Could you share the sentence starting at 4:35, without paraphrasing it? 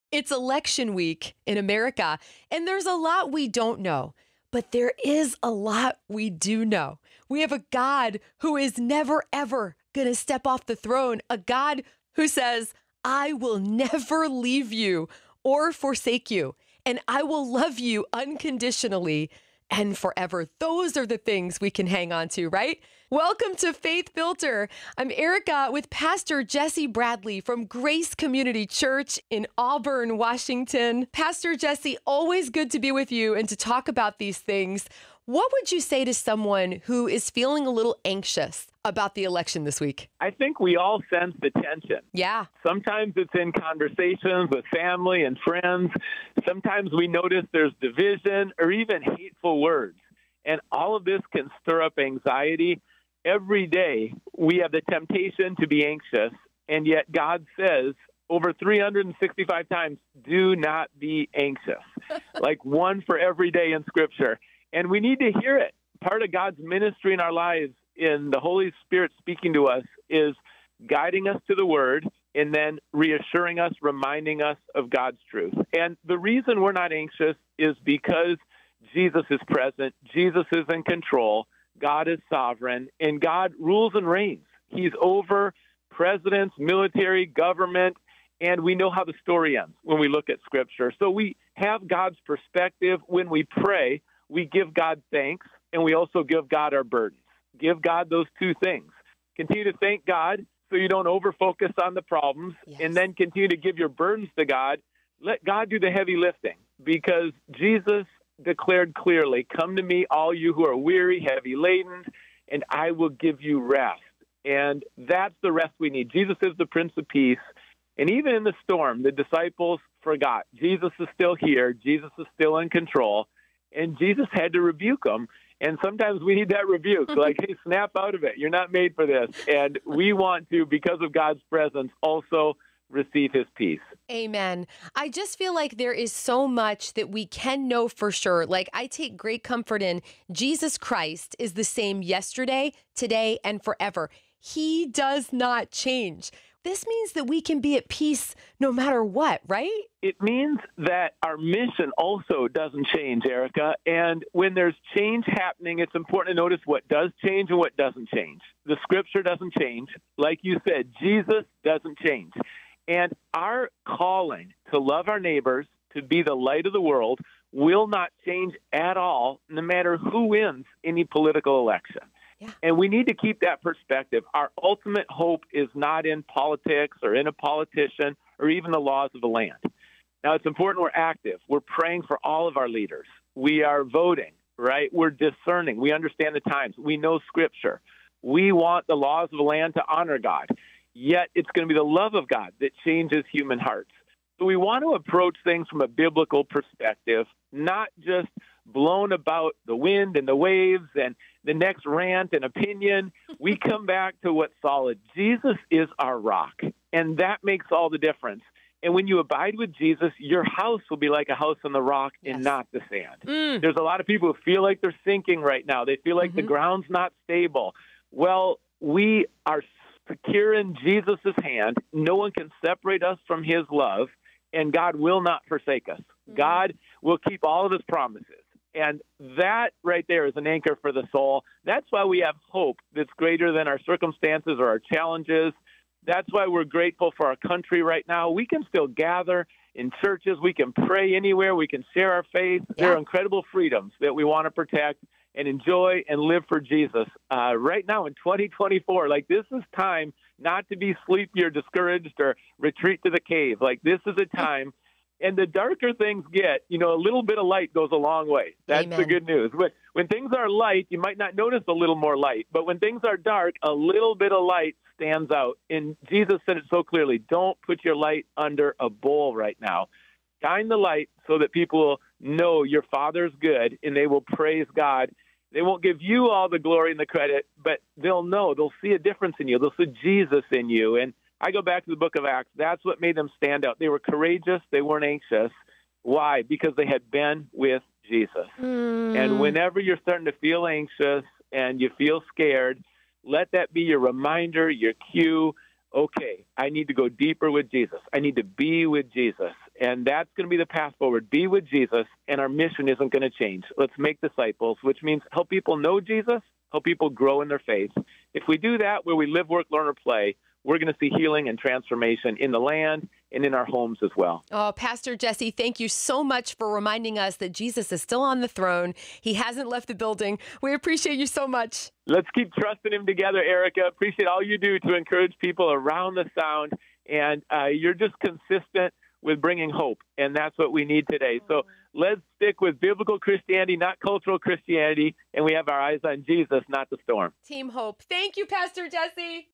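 They won't give you all the glory and the credit, but they'll know.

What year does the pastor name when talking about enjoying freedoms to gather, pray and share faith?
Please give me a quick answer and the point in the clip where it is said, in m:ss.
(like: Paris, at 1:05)
2024, at 4:08.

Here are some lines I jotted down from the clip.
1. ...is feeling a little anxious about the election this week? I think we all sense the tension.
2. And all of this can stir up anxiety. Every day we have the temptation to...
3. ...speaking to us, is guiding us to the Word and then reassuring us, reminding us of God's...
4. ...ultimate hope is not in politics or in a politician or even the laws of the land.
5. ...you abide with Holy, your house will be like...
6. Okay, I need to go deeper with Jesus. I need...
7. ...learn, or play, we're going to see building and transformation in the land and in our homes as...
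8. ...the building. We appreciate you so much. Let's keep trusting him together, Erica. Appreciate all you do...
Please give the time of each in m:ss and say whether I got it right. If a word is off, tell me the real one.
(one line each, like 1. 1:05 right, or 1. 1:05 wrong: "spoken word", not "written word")
1. 0:37 right
2. 0:50 right
3. 1:09 right
4. 2:54 right
5. 3:29 wrong: "Jesus", not "Holy"
6. 4:55 right
7. 5:09 wrong: "healing", not "building"
8. 5:19 right.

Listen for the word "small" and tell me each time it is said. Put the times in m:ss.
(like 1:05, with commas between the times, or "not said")
not said.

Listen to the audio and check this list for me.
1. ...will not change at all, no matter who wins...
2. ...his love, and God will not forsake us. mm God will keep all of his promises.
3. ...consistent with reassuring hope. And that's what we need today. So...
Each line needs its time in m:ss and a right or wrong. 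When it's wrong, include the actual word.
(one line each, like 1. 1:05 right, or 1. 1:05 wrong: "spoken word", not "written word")
1. 2:47 right
2. 3:43 right
3. 5:28 wrong: "bringing", not "reassuring".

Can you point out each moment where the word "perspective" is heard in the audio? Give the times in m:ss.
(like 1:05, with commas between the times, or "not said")
1:32, 2:53, 3:16.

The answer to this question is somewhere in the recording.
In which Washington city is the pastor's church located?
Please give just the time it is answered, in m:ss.
0:29.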